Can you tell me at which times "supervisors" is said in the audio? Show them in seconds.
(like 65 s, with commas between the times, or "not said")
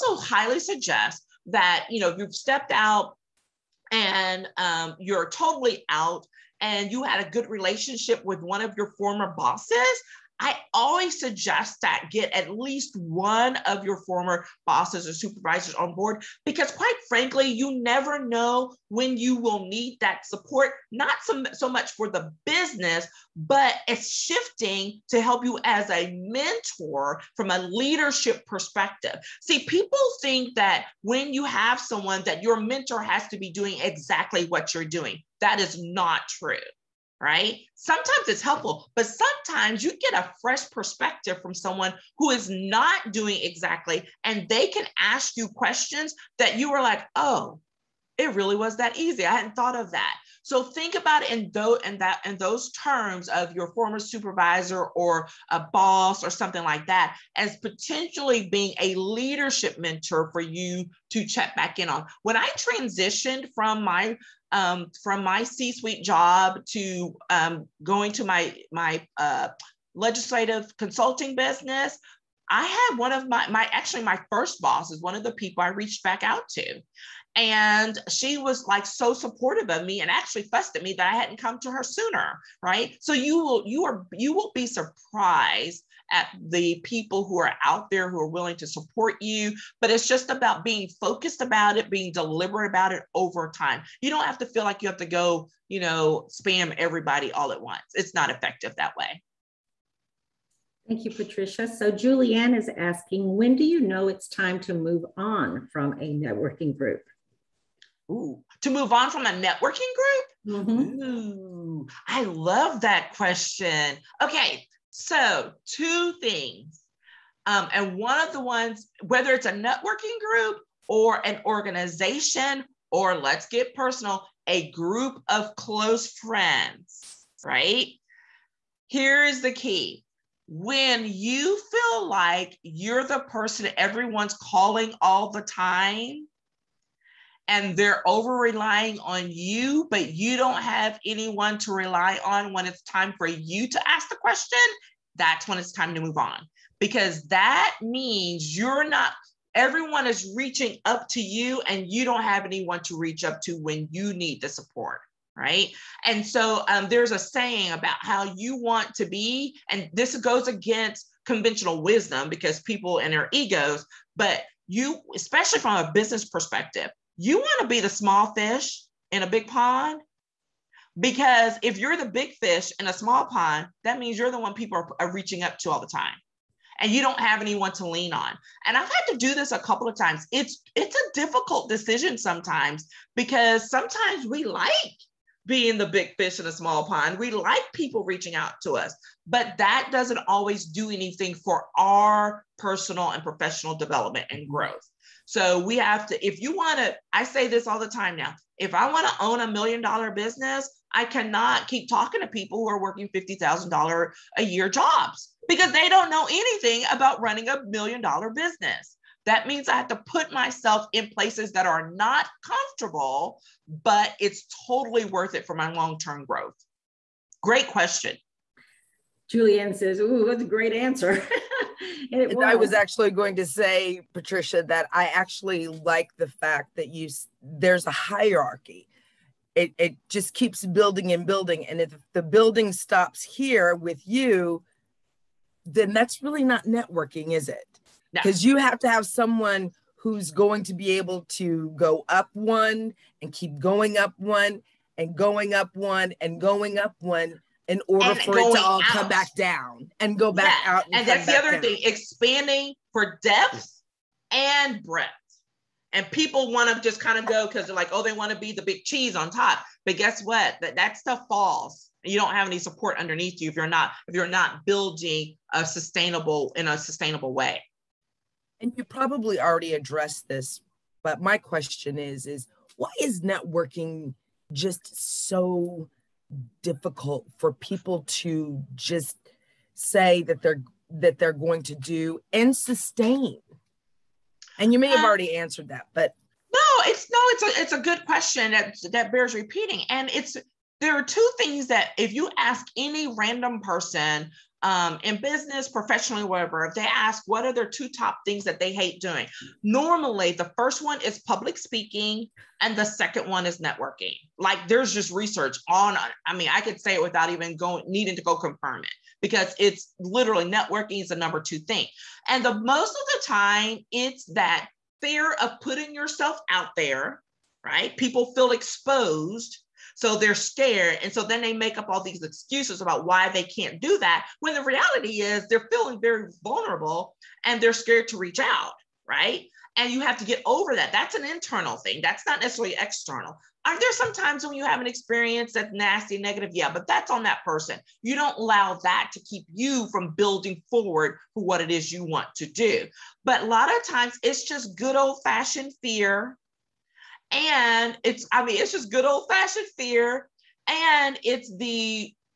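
15 s, 53 s.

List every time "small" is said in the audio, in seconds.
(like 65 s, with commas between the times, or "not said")
167 s, 172 s, 186 s.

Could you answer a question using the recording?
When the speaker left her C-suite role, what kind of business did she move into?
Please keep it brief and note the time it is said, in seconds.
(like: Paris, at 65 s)
legislative consulting business, at 69 s.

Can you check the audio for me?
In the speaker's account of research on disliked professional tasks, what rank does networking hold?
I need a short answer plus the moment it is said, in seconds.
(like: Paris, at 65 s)
number 2, at 311 s.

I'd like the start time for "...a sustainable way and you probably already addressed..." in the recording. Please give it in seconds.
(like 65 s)
266 s.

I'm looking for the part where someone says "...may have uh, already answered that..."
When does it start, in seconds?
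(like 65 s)
284 s.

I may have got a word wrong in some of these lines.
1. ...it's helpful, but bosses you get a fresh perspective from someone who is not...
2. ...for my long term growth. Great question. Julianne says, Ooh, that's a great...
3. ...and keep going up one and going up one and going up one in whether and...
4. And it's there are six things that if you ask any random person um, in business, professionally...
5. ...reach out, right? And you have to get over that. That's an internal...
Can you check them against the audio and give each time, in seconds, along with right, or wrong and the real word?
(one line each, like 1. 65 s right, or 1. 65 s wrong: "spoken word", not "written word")
1. 38 s wrong: "sometimes", not "bosses"
2. 215 s right
3. 243 s wrong: "order", not "whether"
4. 289 s wrong: "two", not "six"
5. 328 s right.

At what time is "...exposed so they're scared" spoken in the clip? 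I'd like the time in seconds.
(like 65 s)
318 s.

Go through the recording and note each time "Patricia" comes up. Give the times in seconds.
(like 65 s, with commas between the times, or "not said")
101 s, 224 s.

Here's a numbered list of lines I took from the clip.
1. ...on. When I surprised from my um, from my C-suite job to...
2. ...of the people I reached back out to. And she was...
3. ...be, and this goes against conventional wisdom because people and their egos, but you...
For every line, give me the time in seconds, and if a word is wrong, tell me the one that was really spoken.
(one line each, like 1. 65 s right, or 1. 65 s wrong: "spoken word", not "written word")
1. 61 s wrong: "transitioned", not "surprised"
2. 75 s right
3. 159 s right.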